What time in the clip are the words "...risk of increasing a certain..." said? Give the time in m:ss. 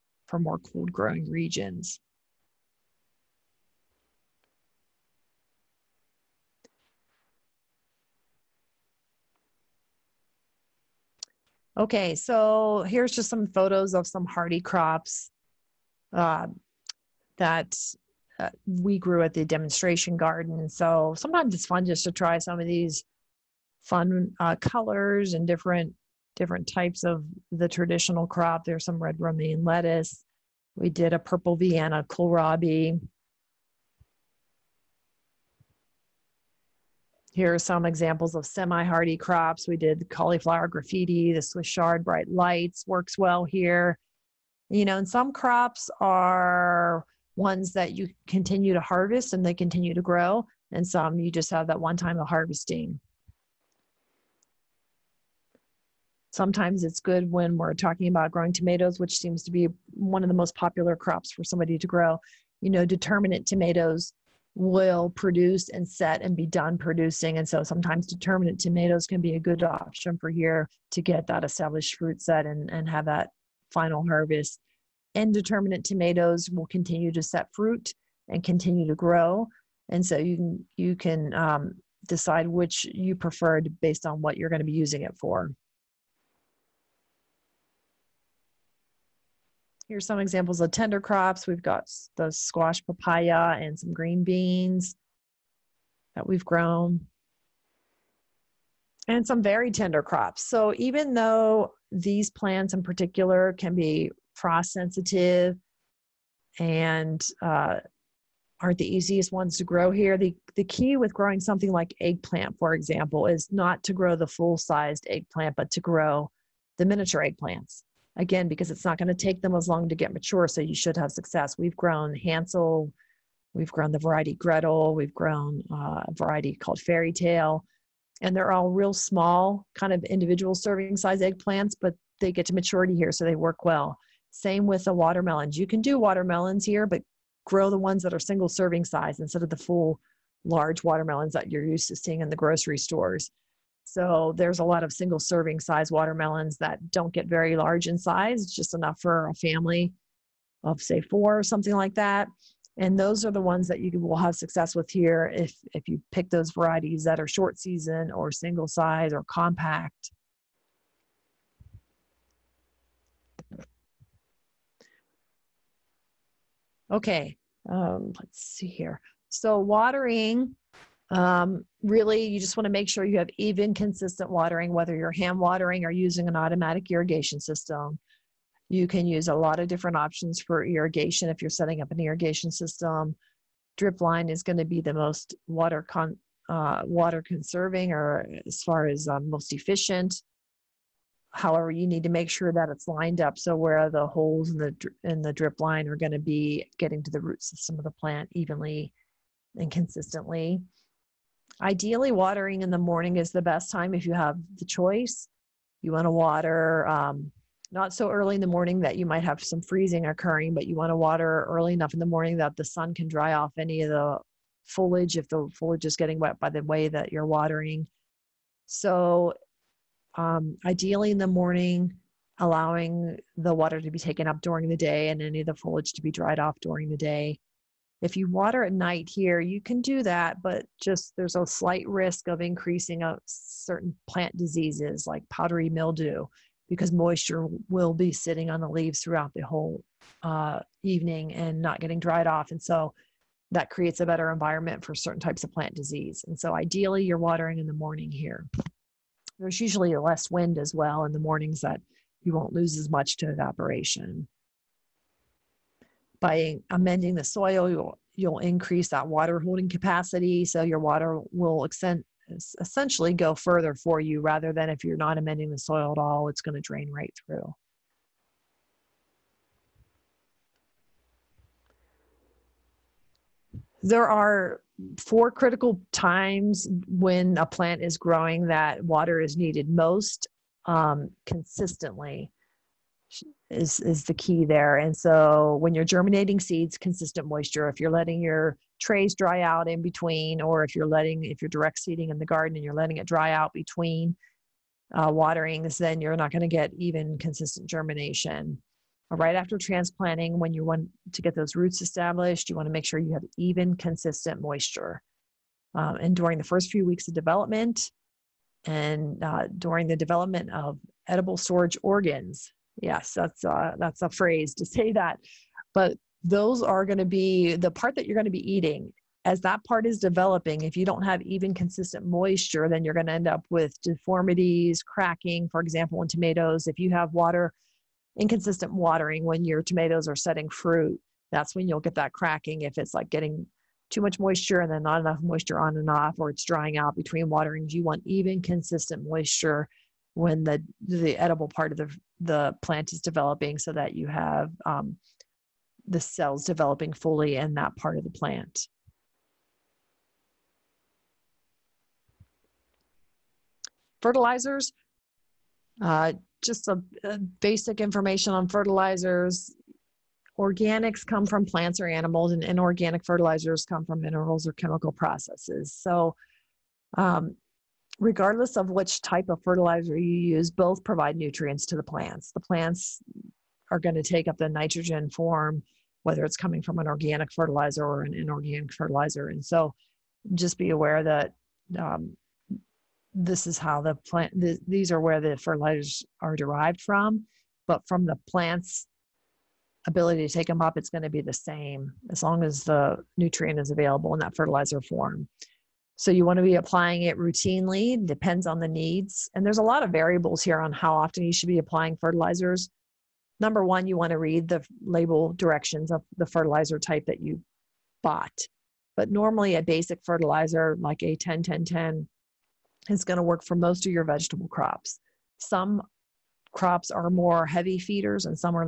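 3:51.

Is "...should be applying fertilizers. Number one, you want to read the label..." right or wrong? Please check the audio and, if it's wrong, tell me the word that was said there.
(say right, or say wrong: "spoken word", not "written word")
right.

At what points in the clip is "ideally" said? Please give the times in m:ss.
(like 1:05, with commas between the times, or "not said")
3:21, 3:40, 4:06.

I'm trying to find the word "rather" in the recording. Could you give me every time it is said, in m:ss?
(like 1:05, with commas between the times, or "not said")
4:24.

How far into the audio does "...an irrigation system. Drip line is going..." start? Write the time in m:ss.
3:01.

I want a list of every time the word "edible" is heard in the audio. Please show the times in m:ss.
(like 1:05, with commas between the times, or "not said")
5:11, 5:41.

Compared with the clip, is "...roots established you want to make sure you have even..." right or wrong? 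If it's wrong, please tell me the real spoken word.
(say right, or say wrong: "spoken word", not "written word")
right.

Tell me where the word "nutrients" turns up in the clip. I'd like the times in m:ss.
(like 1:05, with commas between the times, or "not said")
6:11, 6:33.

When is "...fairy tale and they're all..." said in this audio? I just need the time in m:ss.
2:06.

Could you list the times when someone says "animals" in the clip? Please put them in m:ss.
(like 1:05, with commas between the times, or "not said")
6:01.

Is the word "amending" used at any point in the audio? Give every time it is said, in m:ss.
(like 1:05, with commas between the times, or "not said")
4:16, 4:25.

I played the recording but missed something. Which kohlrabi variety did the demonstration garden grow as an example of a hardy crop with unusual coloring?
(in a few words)
Purple Vienna.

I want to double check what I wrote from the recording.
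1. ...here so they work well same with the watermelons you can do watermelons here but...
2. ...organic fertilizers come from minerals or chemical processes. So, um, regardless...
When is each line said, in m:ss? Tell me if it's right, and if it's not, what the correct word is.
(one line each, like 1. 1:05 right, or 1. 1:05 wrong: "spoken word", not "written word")
1. 2:12 right
2. 6:02 wrong: "inorganic", not "organic".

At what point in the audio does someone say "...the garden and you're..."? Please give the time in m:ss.
4:52.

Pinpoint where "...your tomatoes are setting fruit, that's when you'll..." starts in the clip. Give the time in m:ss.
5:29.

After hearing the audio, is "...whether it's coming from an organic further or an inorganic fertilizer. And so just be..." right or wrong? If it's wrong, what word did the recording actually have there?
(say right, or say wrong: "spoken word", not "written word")
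wrong: "fertilizer", not "further".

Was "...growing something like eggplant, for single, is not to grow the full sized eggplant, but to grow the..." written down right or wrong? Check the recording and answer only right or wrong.
wrong.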